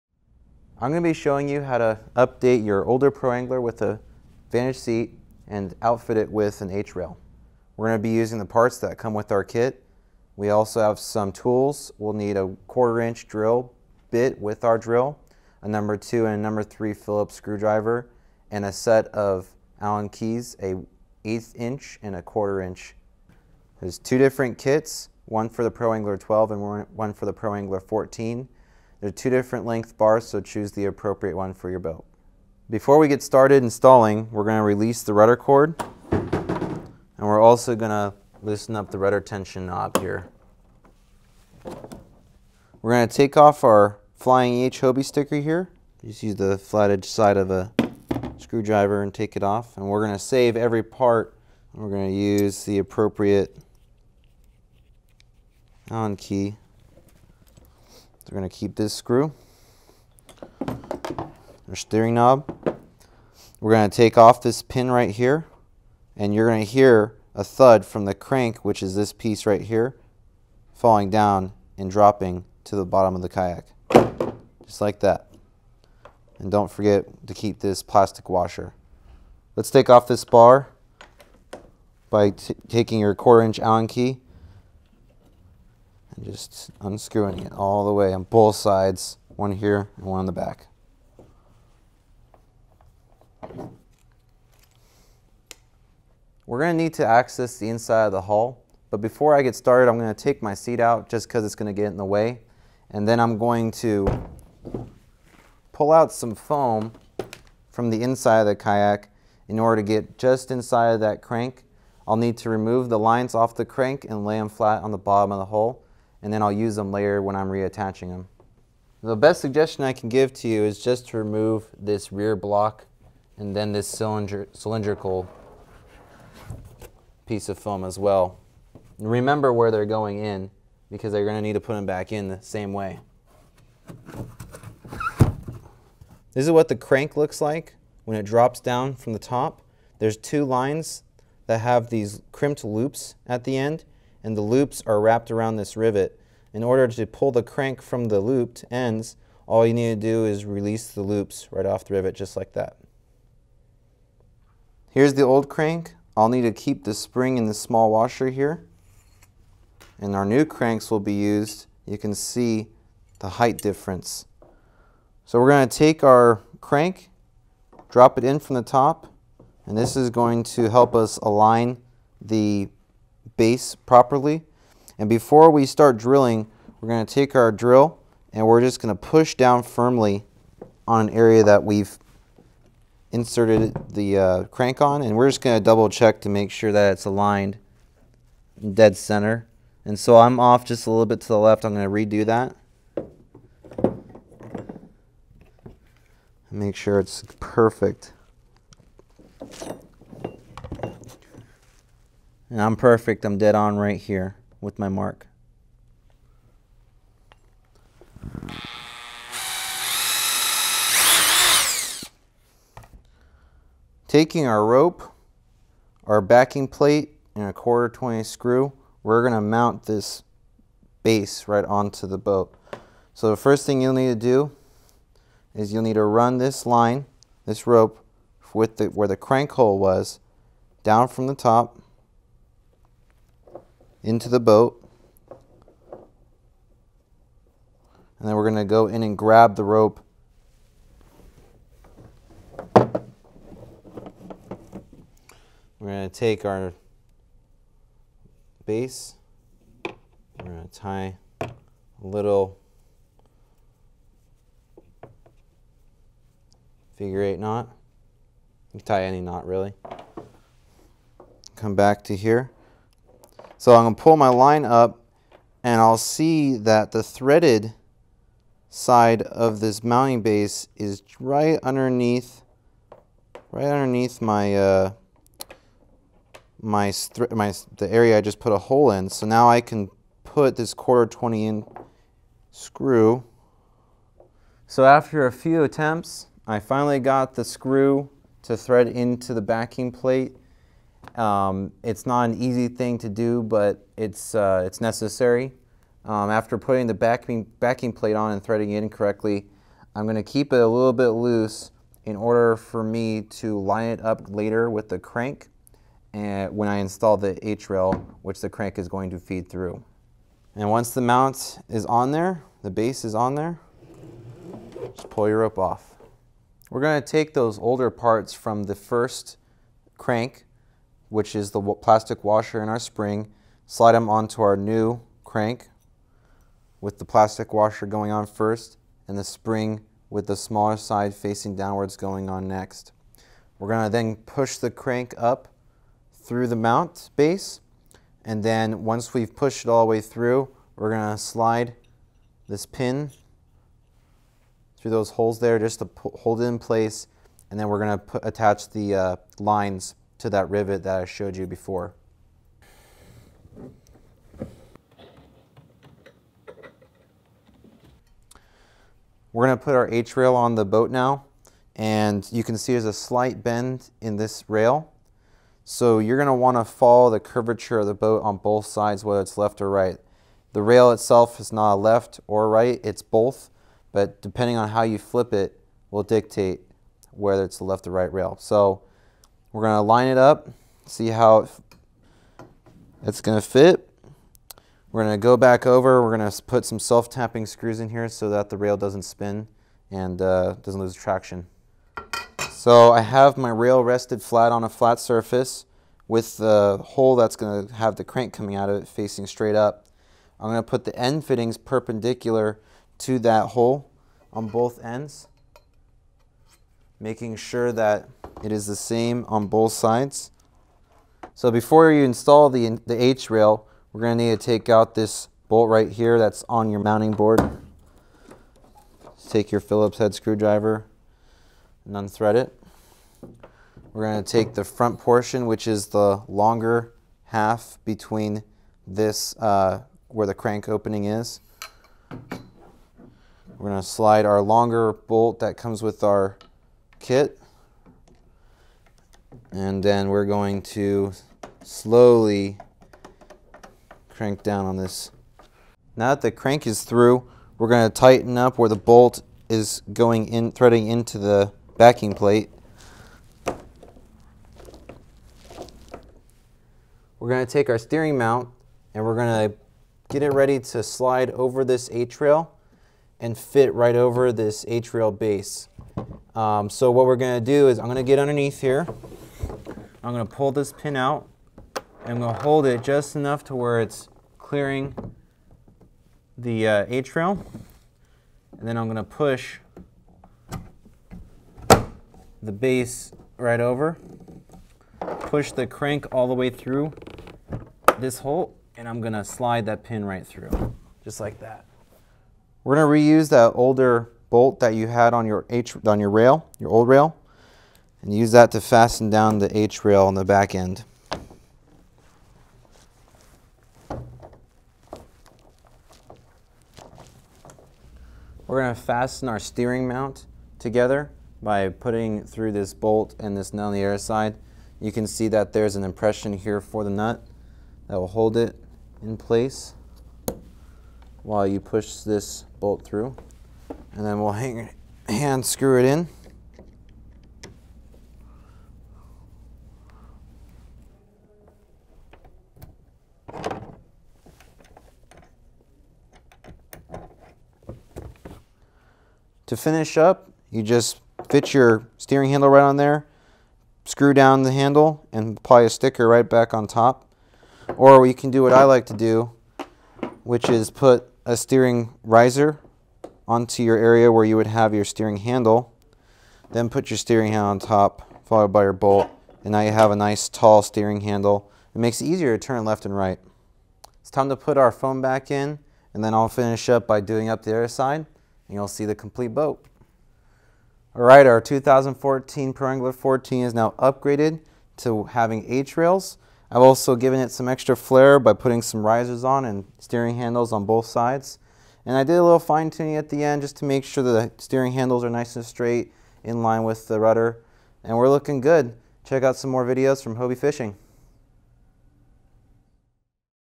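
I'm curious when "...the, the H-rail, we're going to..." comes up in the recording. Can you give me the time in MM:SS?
06:52.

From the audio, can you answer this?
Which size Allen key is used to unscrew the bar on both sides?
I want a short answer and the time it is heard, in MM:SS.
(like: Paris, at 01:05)
1/4 inch, at 01:23.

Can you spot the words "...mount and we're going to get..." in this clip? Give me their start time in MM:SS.
07:38.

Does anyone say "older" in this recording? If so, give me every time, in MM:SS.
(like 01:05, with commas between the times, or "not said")
00:02, 05:17, 08:13.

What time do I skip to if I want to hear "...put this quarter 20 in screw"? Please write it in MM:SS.
04:40.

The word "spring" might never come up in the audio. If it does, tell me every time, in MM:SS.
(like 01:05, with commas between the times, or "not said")
02:36, 05:22, 05:29.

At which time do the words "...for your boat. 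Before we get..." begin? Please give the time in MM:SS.
00:31.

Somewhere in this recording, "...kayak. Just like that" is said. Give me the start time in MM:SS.
01:13.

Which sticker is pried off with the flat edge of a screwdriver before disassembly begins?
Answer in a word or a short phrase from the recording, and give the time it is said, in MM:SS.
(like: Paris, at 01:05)
Flying H Hobie sticker, at 00:44.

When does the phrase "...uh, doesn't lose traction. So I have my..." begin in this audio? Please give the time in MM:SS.
06:30.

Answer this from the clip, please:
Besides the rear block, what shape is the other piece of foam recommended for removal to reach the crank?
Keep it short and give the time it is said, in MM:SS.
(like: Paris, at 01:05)
Cylindrical, at 02:04.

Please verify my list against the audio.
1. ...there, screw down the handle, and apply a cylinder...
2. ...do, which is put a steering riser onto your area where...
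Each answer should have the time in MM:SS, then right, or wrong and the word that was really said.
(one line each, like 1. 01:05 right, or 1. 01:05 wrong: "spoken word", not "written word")
1. 09:02 wrong: "sticker", not "cylinder"
2. 09:08 right.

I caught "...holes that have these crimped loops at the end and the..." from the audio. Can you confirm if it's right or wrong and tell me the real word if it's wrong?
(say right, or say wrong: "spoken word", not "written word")
wrong: "lines", not "holes".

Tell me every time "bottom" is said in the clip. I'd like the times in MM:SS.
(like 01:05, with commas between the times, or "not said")
01:12, 01:54.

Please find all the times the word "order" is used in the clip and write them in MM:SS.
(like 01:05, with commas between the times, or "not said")
01:49, 02:26, 05:02.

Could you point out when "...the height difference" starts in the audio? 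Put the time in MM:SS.
02:43.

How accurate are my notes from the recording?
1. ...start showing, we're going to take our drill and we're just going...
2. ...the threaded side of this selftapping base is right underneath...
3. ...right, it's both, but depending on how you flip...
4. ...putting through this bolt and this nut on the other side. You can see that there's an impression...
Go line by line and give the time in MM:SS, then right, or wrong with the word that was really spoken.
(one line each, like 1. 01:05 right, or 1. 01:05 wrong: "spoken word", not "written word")
1. 02:55 wrong: "drilling", not "showing"
2. 04:26 wrong: "mounting", not "selftapping"
3. 06:12 right
4. 08:31 right.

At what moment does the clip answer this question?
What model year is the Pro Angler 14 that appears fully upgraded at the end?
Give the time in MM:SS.
09:31.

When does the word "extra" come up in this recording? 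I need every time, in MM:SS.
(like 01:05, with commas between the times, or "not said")
09:37.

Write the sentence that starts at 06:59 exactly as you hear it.
Take your Phillips head screwdriver and unthread it.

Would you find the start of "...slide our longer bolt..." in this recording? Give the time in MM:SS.
07:13.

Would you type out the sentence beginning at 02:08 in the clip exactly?
Remember where they're going in because they're going to need to put them back in the same way.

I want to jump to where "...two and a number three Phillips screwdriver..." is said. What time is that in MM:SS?
00:15.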